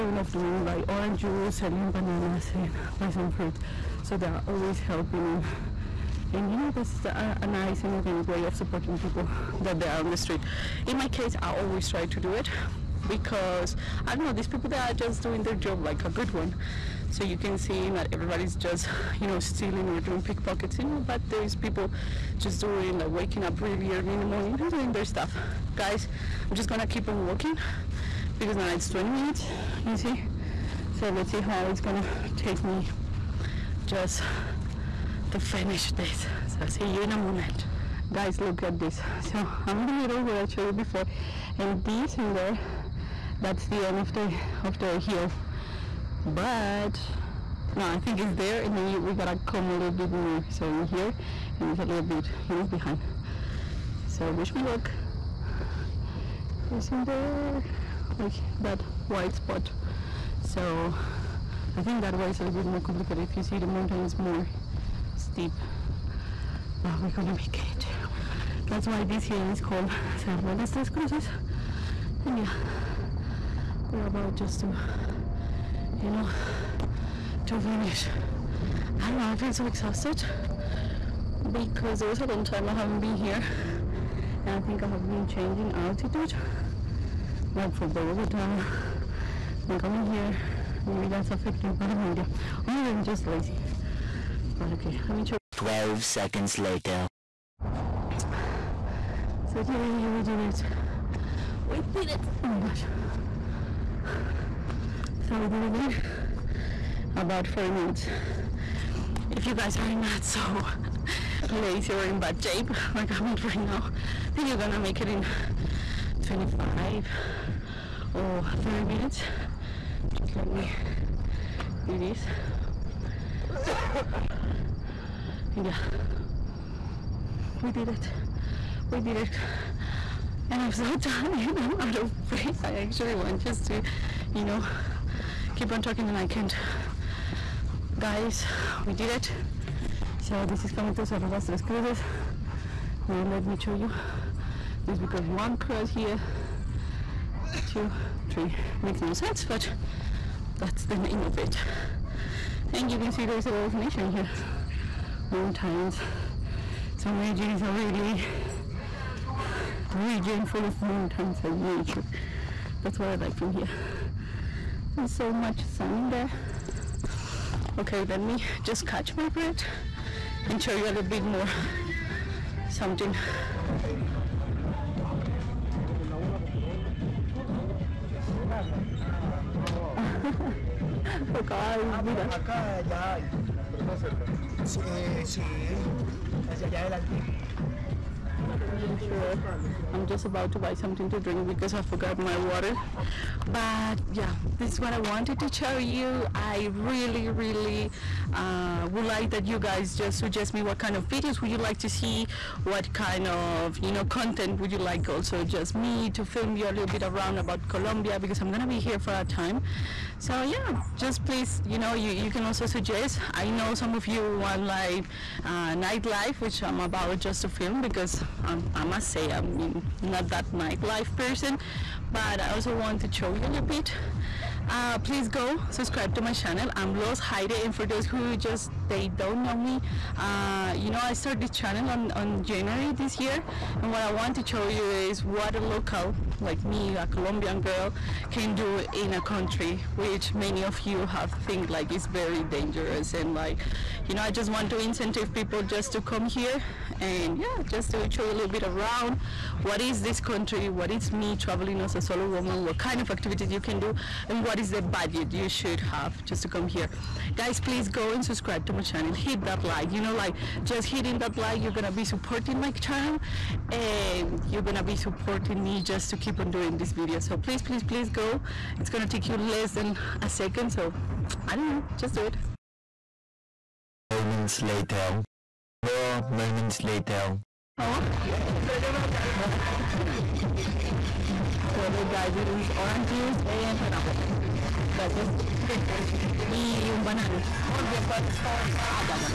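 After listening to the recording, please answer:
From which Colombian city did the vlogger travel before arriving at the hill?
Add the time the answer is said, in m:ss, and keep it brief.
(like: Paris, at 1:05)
Bogota, at 1:27.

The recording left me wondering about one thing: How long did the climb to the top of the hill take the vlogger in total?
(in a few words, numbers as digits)
About 40 minutes.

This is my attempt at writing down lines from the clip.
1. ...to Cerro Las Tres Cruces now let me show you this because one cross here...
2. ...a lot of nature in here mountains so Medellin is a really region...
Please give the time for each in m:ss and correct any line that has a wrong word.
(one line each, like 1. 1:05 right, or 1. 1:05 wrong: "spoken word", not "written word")
1. 2:20 right
2. 2:33 right.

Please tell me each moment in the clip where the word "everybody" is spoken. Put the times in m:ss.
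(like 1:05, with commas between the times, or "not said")
0:18.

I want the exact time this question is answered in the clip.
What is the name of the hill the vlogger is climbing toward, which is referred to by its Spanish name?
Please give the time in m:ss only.
1:10.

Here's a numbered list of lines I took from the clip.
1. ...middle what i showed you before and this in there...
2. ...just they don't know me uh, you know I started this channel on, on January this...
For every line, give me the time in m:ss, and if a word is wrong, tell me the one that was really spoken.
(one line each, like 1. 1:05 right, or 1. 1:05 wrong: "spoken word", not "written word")
1. 0:39 right
2. 3:48 right.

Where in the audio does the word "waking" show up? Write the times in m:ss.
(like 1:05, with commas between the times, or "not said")
0:23.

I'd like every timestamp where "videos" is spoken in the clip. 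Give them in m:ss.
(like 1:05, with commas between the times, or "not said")
3:21, 4:26.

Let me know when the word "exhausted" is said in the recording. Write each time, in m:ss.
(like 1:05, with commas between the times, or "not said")
1:19.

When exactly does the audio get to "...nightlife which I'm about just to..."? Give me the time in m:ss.
3:35.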